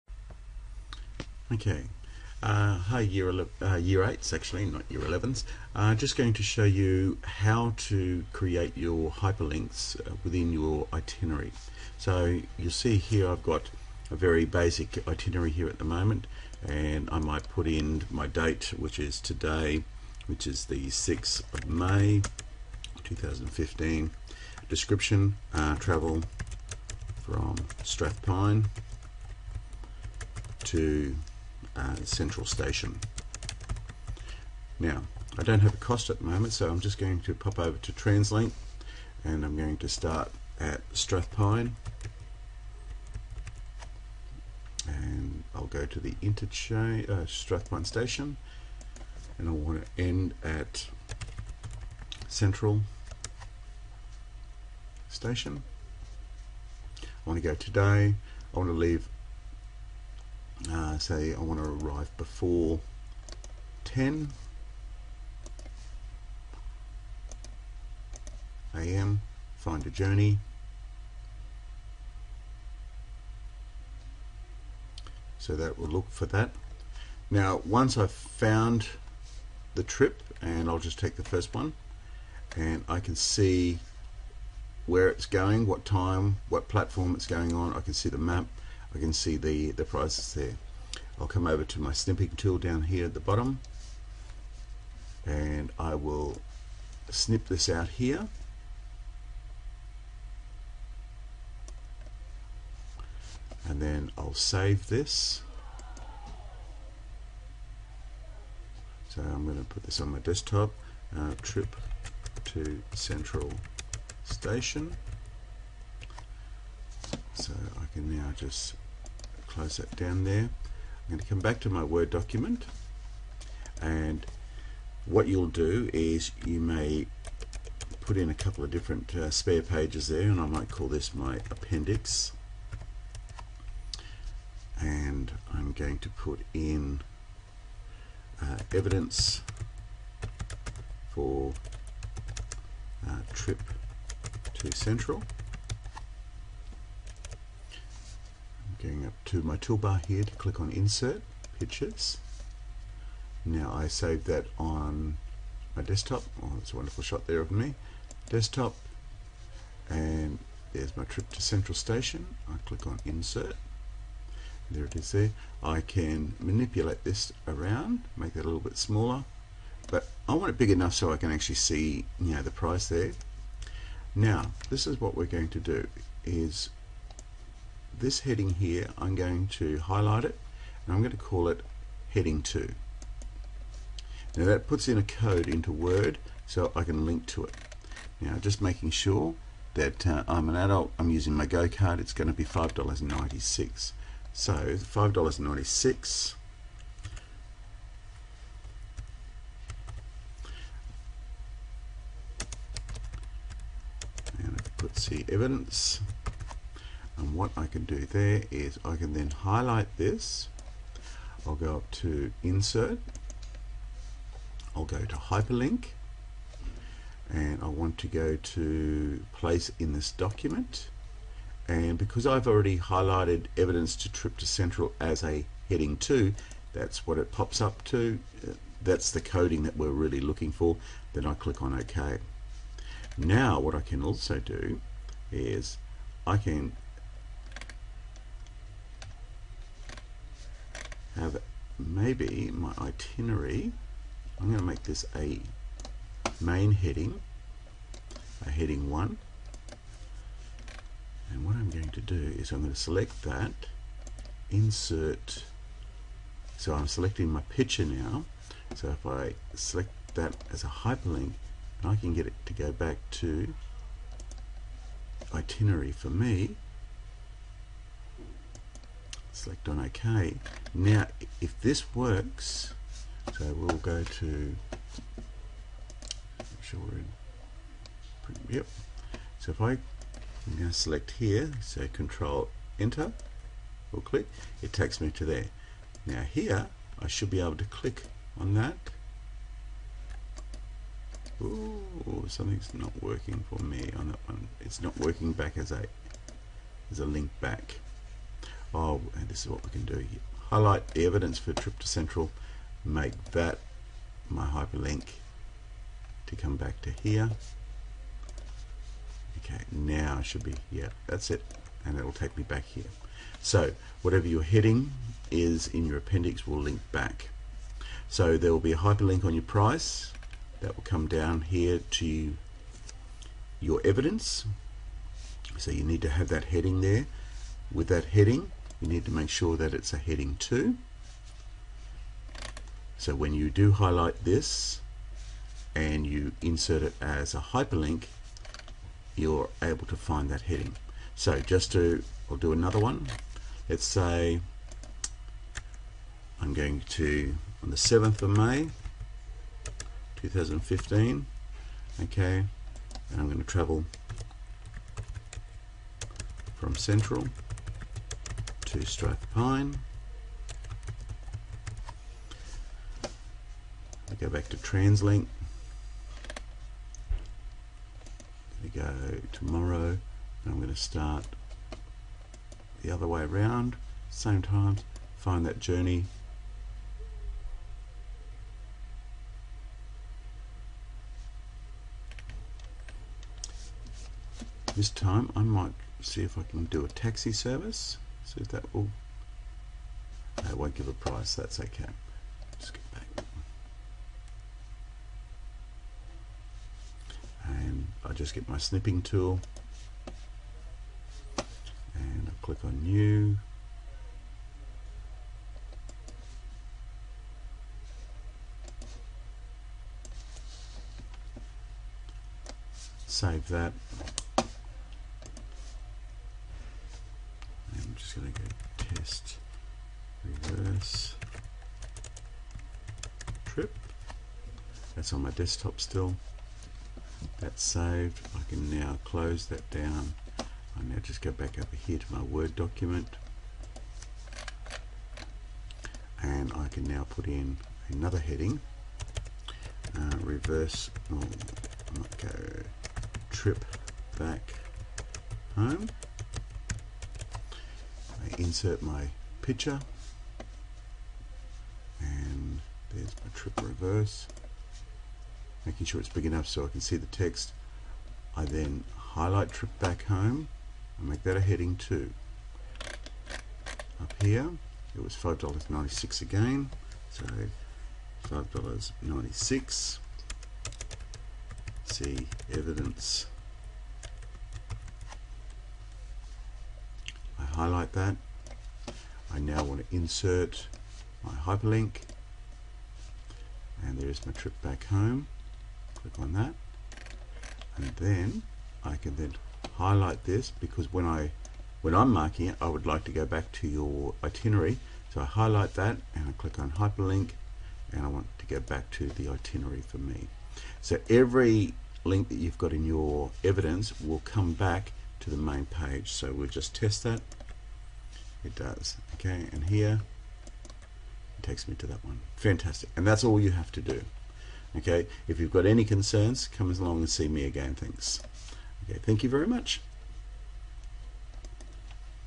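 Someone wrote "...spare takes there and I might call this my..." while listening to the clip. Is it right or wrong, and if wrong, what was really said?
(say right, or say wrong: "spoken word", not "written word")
wrong: "pages", not "takes".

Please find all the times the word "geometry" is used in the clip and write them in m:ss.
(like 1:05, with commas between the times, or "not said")
not said.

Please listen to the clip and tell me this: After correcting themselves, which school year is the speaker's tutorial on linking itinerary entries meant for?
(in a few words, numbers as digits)
Year 8.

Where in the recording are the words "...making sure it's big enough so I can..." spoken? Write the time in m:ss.
7:35.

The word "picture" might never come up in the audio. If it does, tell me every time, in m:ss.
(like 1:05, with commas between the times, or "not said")
2:31, 4:17, 7:29.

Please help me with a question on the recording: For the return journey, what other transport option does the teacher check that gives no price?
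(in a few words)
taxi service.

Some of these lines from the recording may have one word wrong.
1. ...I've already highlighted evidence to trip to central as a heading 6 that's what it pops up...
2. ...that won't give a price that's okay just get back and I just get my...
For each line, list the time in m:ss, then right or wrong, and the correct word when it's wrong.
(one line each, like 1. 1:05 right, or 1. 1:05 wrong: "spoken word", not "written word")
1. 3:42 wrong: "2", not "6"
2. 6:30 right.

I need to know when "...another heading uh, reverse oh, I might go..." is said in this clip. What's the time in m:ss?
7:17.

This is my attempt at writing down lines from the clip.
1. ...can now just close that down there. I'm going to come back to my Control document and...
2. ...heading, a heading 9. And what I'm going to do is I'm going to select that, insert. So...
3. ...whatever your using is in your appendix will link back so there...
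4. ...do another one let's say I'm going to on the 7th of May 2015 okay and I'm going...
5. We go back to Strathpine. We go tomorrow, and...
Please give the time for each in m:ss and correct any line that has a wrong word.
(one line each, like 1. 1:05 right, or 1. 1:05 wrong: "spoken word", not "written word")
1. 1:57 wrong: "Word", not "Control"
2. 4:06 wrong: "1", not "9"
3. 5:14 wrong: "heading", not "using"
4. 5:42 right
5. 6:04 wrong: "TransLink", not "Strathpine".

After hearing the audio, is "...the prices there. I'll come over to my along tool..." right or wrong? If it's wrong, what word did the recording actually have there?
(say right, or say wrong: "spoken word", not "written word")
wrong: "snipping", not "along".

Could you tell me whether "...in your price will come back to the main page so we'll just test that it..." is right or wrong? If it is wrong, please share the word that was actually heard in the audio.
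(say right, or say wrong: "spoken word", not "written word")
wrong: "evidence", not "price".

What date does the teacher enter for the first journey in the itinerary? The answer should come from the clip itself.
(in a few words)
6 May 2015.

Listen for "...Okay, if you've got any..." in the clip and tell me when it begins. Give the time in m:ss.
8:34.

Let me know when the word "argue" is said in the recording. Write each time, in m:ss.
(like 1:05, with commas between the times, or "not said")
not said.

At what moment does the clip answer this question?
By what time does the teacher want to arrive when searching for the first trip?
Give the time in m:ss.
1:03.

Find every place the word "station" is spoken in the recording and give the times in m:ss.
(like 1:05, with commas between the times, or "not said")
0:32, 0:47, 0:55, 1:54, 2:41.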